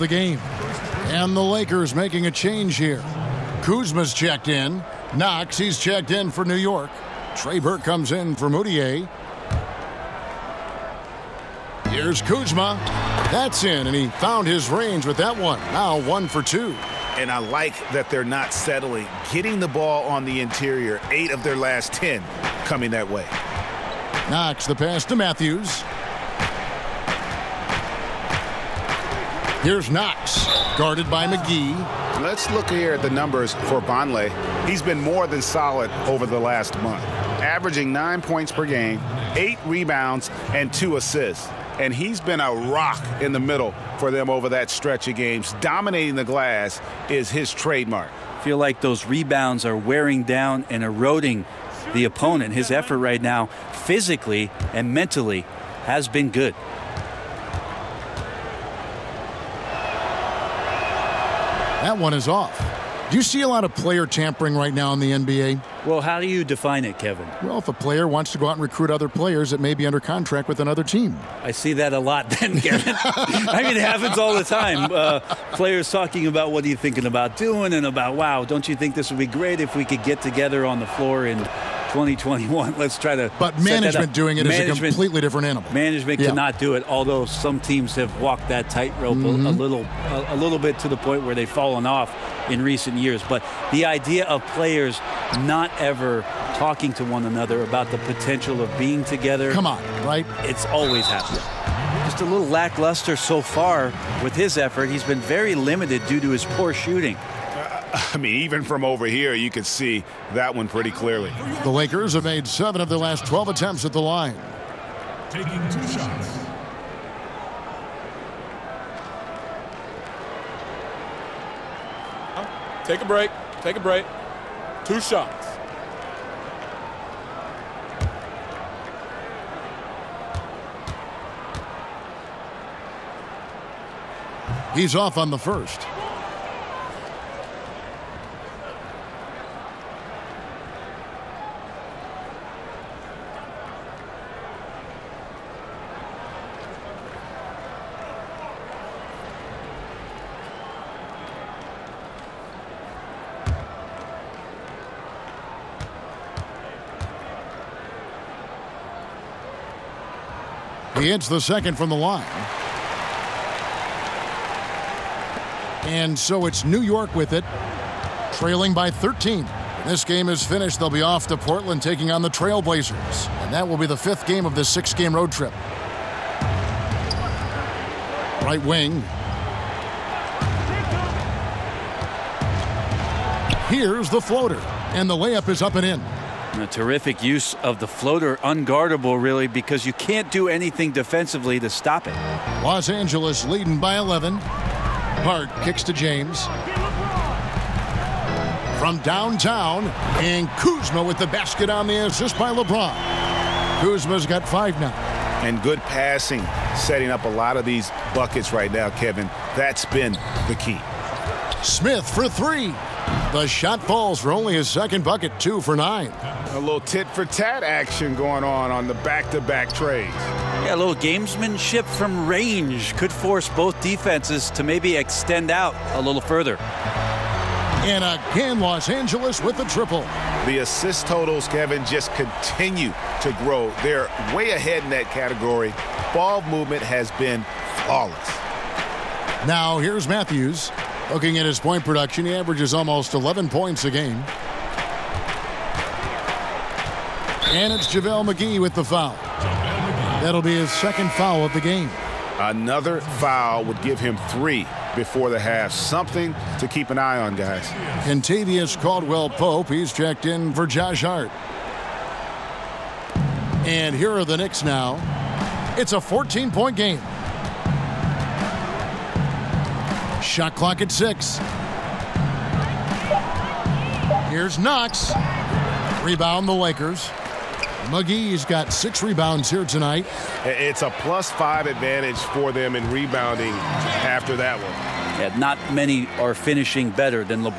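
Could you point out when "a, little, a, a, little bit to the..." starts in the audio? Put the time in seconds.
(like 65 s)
89 s.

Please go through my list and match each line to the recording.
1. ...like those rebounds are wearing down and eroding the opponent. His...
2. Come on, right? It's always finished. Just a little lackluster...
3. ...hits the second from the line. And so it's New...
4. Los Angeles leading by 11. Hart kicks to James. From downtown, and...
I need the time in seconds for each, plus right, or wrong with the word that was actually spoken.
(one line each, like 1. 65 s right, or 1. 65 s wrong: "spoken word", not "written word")
1. 48 s right
2. 99 s wrong: "happened", not "finished"
3. 161 s right
4. 192 s right.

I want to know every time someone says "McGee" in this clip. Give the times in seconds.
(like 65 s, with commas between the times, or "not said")
31 s, 248 s, 277 s.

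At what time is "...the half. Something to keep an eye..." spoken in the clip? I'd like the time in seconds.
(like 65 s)
255 s.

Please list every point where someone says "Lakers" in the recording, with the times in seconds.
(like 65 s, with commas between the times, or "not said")
1 s, 111 s, 276 s.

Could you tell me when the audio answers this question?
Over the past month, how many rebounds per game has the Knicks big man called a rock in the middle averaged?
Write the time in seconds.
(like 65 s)
39 s.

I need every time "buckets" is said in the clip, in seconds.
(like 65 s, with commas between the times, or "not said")
208 s, 215 s.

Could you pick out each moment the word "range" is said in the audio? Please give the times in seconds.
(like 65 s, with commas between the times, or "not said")
14 s, 222 s.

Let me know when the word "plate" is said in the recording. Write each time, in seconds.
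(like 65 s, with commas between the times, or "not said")
not said.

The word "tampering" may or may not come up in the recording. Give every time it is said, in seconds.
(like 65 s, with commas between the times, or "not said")
64 s.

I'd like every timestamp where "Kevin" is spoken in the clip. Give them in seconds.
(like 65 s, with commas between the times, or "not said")
66 s, 72 s, 208 s, 231 s.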